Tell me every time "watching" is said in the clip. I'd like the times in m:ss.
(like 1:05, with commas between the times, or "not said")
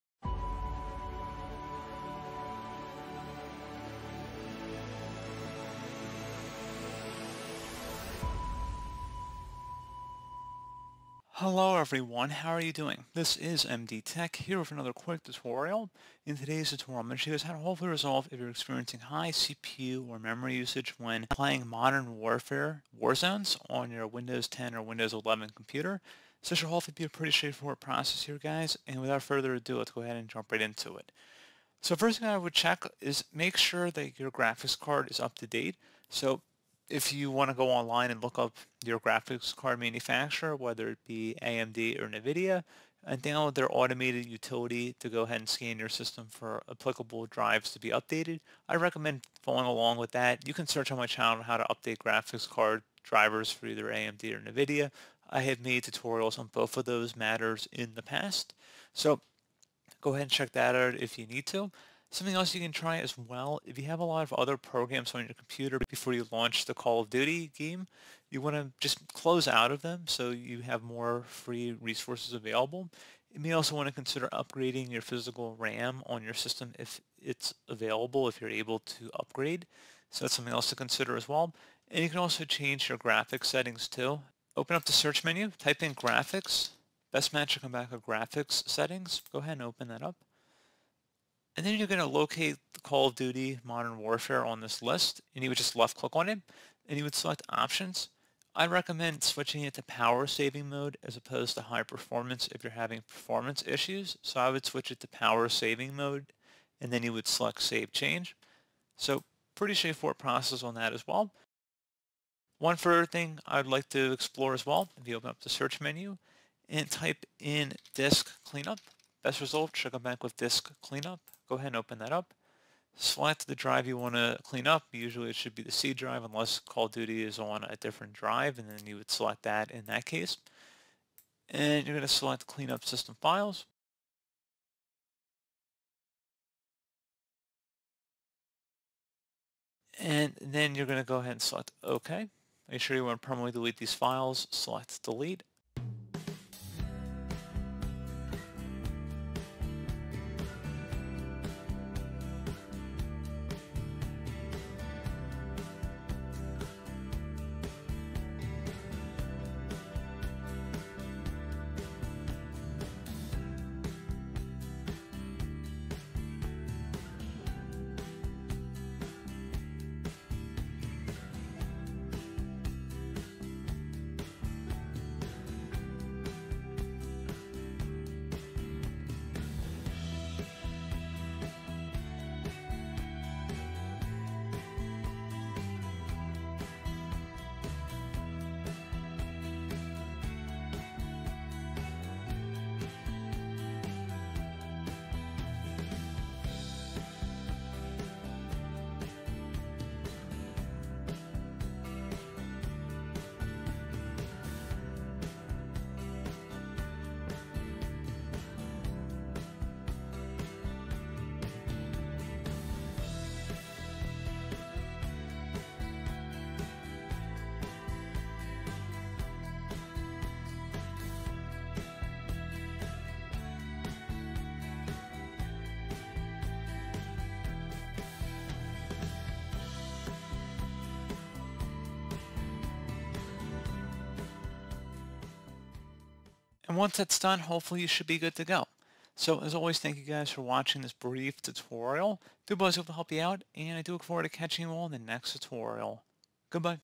4:00.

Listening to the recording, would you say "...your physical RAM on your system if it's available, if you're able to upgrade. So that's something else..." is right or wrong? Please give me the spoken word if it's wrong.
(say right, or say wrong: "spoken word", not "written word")
right.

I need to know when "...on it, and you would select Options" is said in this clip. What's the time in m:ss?
1:36.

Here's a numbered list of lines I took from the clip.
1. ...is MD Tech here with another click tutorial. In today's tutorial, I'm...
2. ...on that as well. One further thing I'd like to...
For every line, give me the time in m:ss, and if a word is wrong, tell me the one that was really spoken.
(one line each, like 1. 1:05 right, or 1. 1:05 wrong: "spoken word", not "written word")
1. 0:13 wrong: "quick", not "click"
2. 1:50 right.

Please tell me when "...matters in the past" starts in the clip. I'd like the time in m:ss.
0:57.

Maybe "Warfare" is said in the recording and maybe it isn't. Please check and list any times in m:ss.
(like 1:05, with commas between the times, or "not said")
0:22, 1:33.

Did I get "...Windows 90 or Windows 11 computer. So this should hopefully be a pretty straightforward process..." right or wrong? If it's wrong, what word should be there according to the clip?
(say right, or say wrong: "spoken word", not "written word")
wrong: "10", not "90".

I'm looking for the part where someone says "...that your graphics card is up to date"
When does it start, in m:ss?
0:33.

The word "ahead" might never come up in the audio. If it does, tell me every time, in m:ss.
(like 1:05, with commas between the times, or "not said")
0:30, 0:45, 1:00, 1:29, 2:01, 2:21.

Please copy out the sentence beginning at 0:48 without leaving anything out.
I recommend following along with that.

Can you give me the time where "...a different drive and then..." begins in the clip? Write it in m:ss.
2:07.